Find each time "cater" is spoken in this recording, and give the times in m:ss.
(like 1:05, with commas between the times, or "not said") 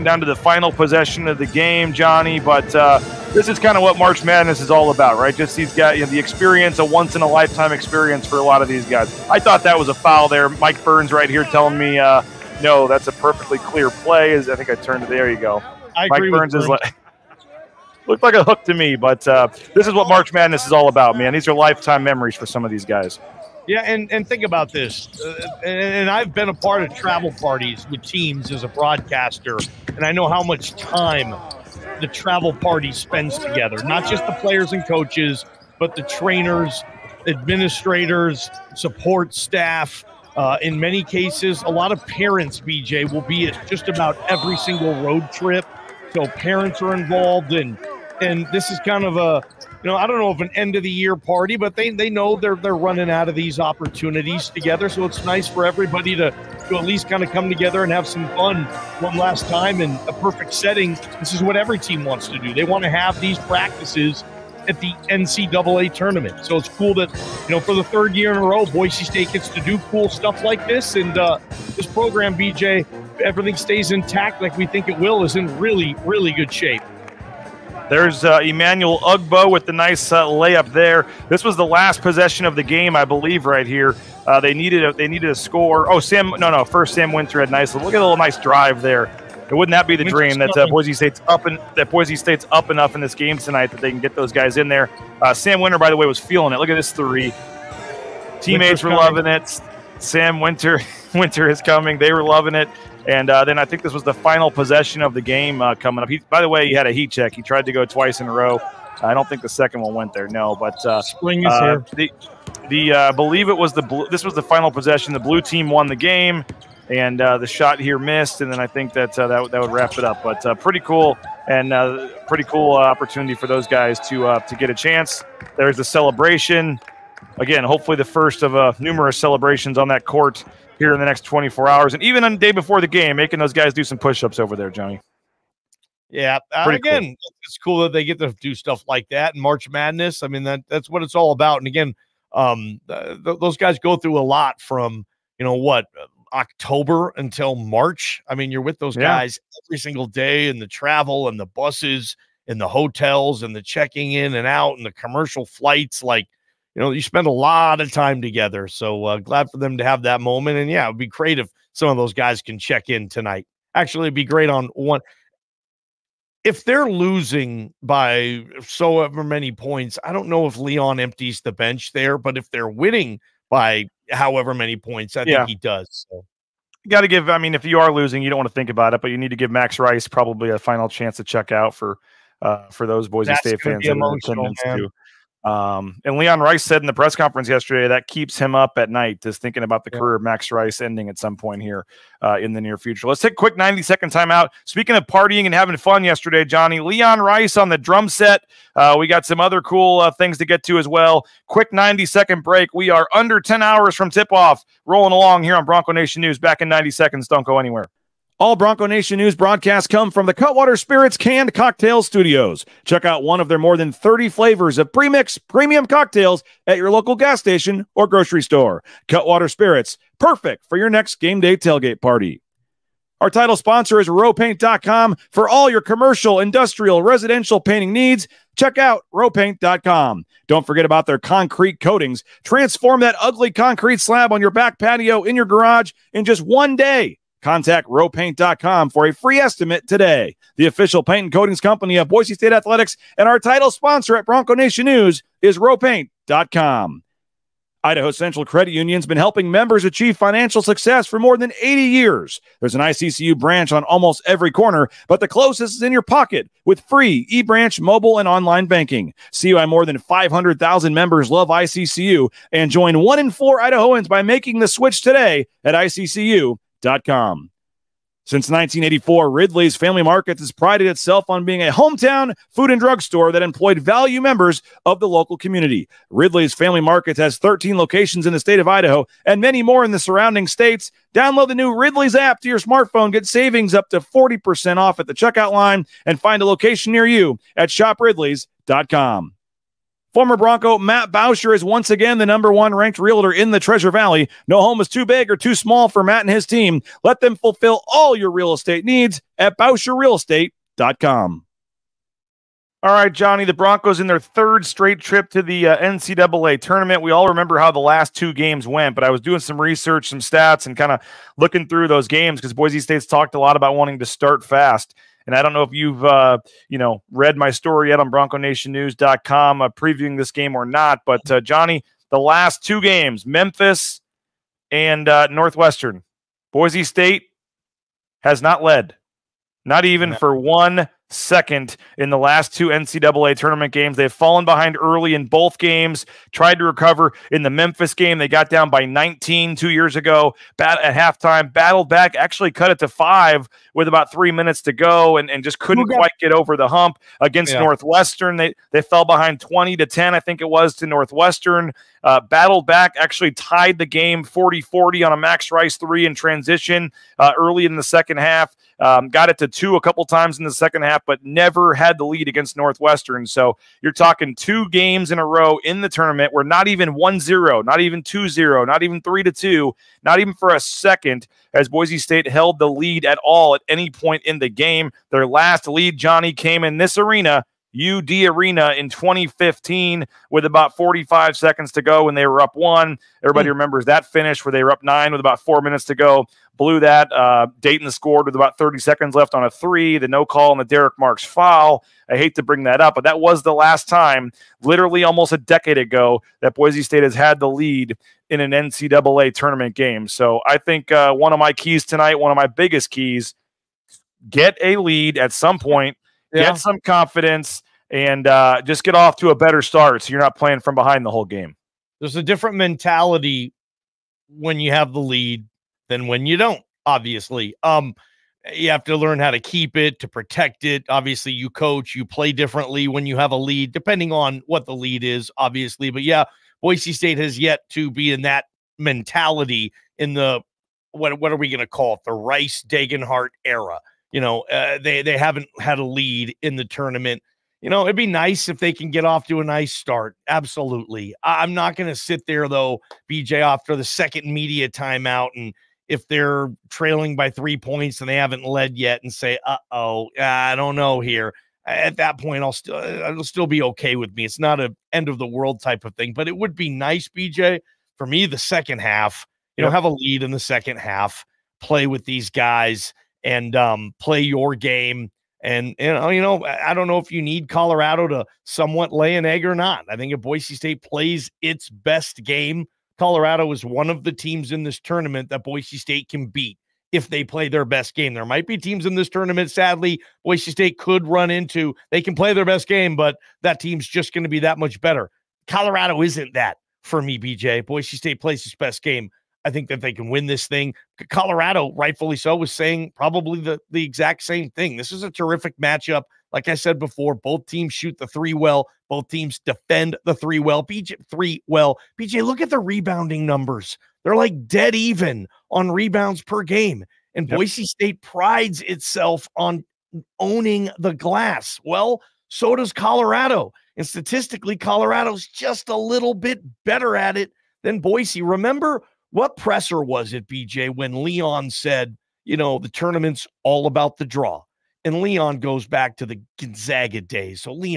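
not said.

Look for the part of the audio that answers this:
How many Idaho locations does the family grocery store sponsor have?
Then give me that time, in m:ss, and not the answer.
4:37.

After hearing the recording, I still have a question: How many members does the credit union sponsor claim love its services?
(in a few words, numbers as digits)
500,000.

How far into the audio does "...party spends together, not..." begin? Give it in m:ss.
0:32.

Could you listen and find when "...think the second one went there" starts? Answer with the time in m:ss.
1:49.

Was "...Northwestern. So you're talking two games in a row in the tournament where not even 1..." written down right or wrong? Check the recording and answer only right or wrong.
right.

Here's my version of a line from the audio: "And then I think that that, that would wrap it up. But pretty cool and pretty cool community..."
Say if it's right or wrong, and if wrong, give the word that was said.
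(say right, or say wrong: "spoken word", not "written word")
wrong: "opportunity", not "community".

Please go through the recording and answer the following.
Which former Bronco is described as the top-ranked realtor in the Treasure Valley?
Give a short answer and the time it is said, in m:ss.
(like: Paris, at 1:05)
Matt Bauscher, at 4:50.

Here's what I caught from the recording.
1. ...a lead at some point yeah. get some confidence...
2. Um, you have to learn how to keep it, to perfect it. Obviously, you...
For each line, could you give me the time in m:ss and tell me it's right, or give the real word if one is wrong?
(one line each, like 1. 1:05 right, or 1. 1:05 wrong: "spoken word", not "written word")
1. 6:44 right
2. 6:57 wrong: "protect", not "perfect".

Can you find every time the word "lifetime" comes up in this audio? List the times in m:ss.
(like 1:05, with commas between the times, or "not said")
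0:07, 0:21.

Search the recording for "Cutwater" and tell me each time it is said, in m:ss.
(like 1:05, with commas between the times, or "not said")
3:30, 3:39.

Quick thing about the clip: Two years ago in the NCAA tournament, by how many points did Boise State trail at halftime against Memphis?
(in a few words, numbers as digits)
19.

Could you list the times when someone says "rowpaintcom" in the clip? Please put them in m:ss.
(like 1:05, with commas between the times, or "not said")
3:44, 3:49, 3:57, 4:05.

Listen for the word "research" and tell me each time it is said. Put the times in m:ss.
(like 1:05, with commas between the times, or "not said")
5:09.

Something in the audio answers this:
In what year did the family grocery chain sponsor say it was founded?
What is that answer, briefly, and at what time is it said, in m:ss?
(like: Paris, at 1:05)
1984, at 4:28.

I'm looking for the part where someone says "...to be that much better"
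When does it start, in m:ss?
8:04.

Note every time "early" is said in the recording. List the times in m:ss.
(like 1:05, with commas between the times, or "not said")
5:34, 5:57.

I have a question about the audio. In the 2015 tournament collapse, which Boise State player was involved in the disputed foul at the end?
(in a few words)
Derrick Marks.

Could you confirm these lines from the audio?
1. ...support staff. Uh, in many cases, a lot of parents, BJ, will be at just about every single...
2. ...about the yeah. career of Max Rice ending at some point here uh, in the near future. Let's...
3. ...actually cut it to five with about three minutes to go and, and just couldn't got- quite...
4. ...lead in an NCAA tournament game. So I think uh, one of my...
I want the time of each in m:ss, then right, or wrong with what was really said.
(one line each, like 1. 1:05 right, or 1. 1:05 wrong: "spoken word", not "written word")
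1. 0:38 right
2. 3:09 right
3. 5:42 right
4. 6:37 right.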